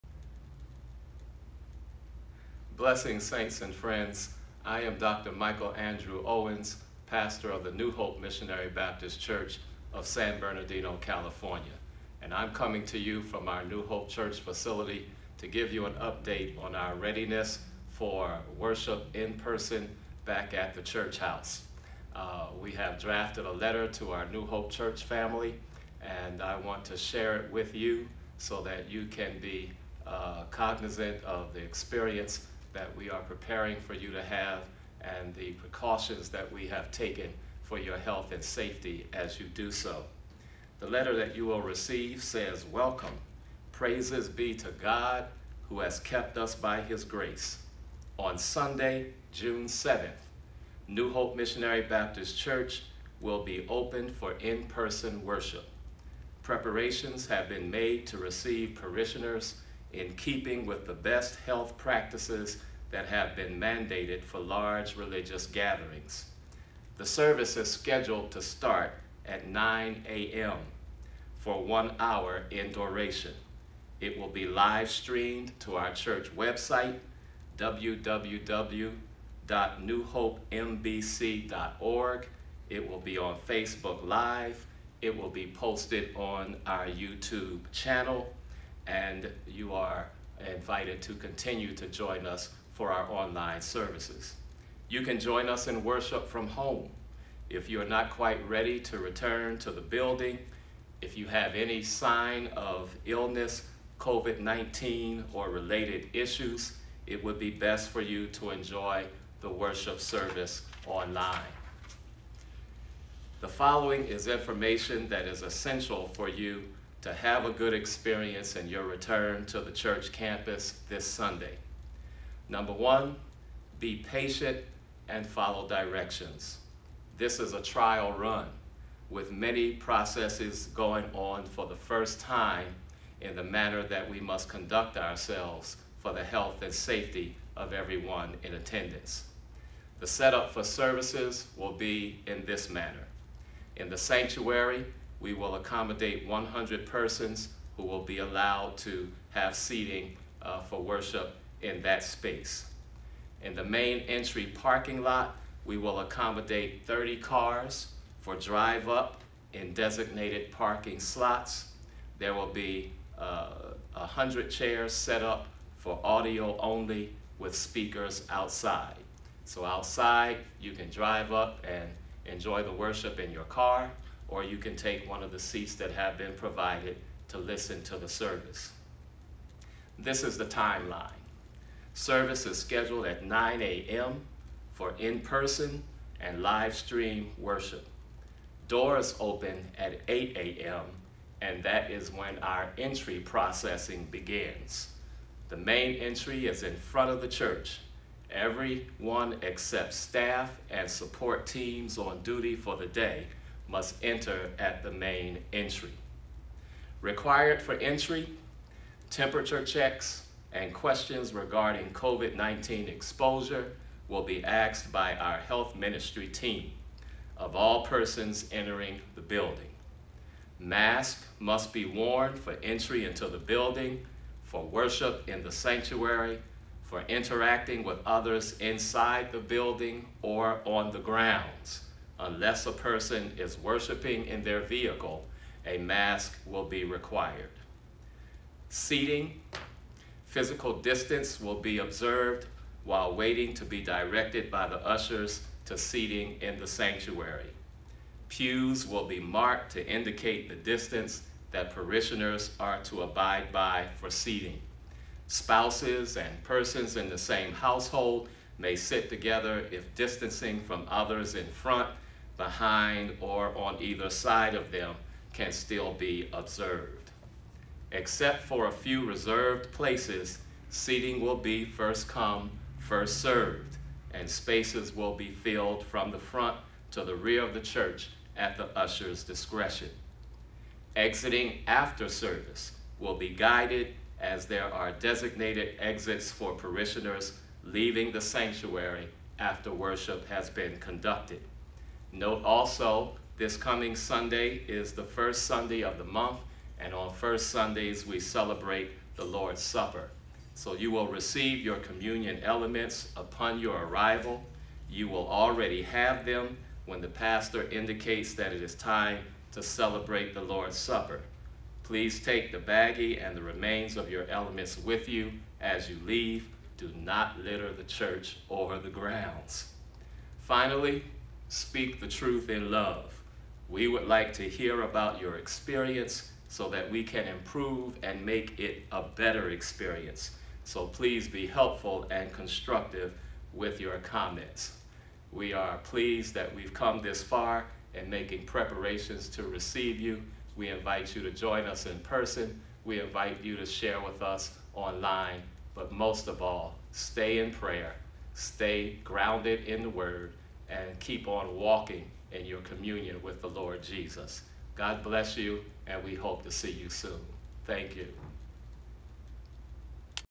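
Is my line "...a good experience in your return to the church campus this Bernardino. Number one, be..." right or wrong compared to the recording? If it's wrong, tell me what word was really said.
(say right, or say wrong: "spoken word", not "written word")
wrong: "Sunday", not "Bernardino".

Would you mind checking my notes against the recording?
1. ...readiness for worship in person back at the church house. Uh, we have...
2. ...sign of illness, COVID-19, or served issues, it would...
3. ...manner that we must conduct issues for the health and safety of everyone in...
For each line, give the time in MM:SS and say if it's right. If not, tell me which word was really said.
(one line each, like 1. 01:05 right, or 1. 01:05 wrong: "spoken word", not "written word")
1. 00:16 right
2. 01:41 wrong: "related", not "served"
3. 02:13 wrong: "ourselves", not "issues".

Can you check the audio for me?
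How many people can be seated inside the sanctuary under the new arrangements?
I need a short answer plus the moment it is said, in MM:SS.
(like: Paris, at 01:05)
100, at 02:26.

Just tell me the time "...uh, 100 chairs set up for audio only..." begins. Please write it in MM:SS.
02:43.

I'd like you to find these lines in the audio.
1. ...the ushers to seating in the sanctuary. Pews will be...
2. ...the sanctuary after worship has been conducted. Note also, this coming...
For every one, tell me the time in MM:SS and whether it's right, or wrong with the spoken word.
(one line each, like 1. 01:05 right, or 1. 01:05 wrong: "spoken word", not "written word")
1. 04:04 right
2. 04:48 right.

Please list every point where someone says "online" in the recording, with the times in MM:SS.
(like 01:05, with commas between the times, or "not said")
01:33, 01:50, 05:44.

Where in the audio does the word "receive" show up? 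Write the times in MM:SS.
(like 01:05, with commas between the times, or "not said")
00:41, 00:58, 05:01, 05:39.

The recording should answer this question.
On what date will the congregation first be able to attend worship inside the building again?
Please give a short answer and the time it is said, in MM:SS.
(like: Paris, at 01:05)
June 7th, at 00:49.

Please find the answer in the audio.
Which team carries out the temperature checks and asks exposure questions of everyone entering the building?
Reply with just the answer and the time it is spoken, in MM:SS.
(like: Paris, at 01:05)
health ministry team, at 03:35.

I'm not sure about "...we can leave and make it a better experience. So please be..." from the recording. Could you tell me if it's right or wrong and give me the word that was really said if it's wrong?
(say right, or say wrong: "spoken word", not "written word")
wrong: "improve", not "leave".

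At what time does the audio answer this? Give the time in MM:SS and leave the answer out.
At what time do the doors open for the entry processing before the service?
03:10.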